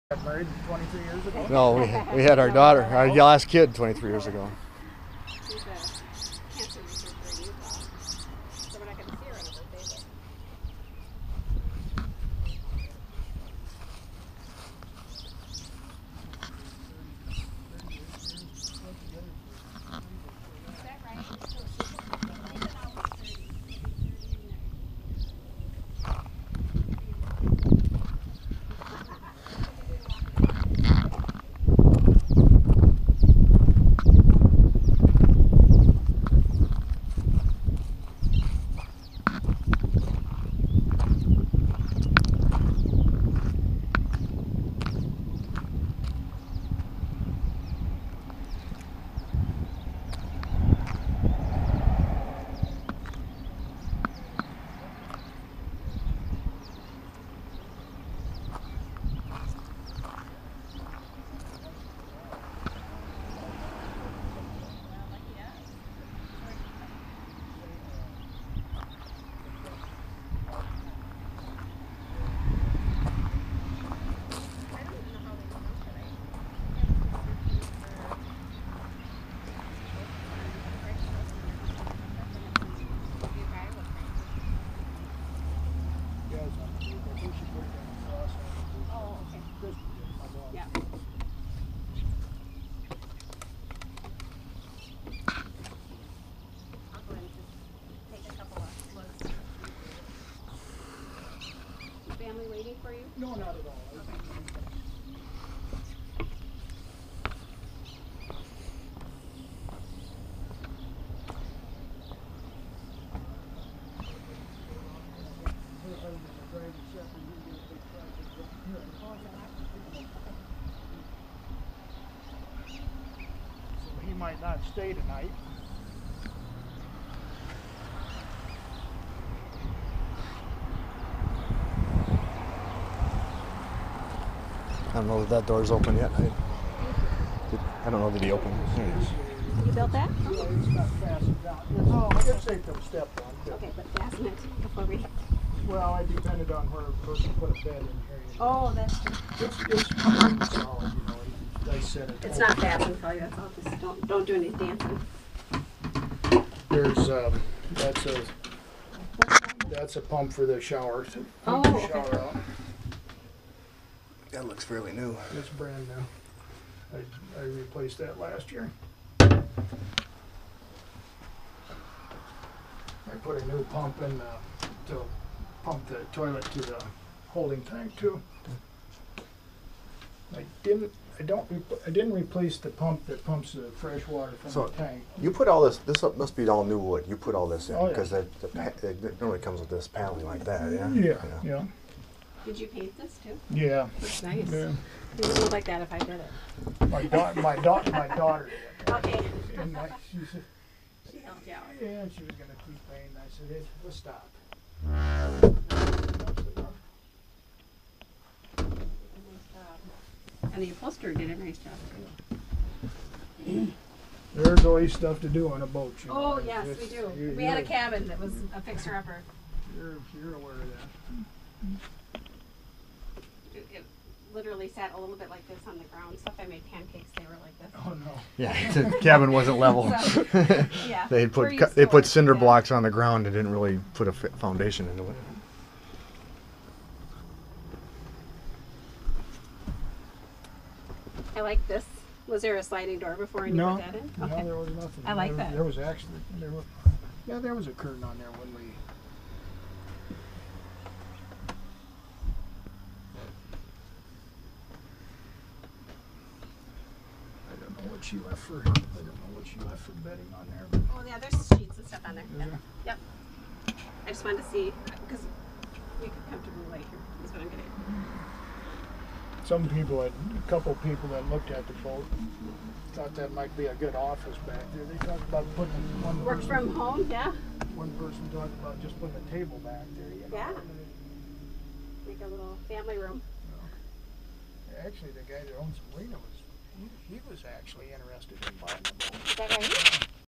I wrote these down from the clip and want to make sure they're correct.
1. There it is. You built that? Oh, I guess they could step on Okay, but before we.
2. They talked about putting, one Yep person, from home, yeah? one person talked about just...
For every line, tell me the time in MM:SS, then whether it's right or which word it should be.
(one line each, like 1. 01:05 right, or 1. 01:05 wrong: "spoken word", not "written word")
1. 02:18 right
2. 04:34 wrong: "Work", not "Yep".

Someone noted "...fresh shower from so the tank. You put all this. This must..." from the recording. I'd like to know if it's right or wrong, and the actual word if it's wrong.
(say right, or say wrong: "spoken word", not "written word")
wrong: "water", not "shower".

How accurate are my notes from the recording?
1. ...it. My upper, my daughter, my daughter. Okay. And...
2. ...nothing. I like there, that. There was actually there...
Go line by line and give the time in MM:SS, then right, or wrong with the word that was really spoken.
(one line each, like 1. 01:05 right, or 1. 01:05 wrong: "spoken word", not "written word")
1. 03:16 wrong: "daughter", not "upper"
2. 04:04 right.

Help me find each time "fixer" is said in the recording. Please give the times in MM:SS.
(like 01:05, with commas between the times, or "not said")
03:38.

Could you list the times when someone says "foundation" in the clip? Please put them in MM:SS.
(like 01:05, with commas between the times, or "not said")
03:54.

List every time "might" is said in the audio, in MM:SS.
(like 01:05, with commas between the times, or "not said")
02:04, 04:33.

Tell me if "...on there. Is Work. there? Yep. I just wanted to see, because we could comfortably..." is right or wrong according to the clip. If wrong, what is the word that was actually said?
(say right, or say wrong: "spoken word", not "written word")
wrong: "Yep", not "Work".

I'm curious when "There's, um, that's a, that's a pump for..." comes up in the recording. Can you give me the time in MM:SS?
02:36.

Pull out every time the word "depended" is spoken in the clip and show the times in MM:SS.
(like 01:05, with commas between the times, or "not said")
02:26.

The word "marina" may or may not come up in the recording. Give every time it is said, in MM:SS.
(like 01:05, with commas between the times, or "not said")
04:45.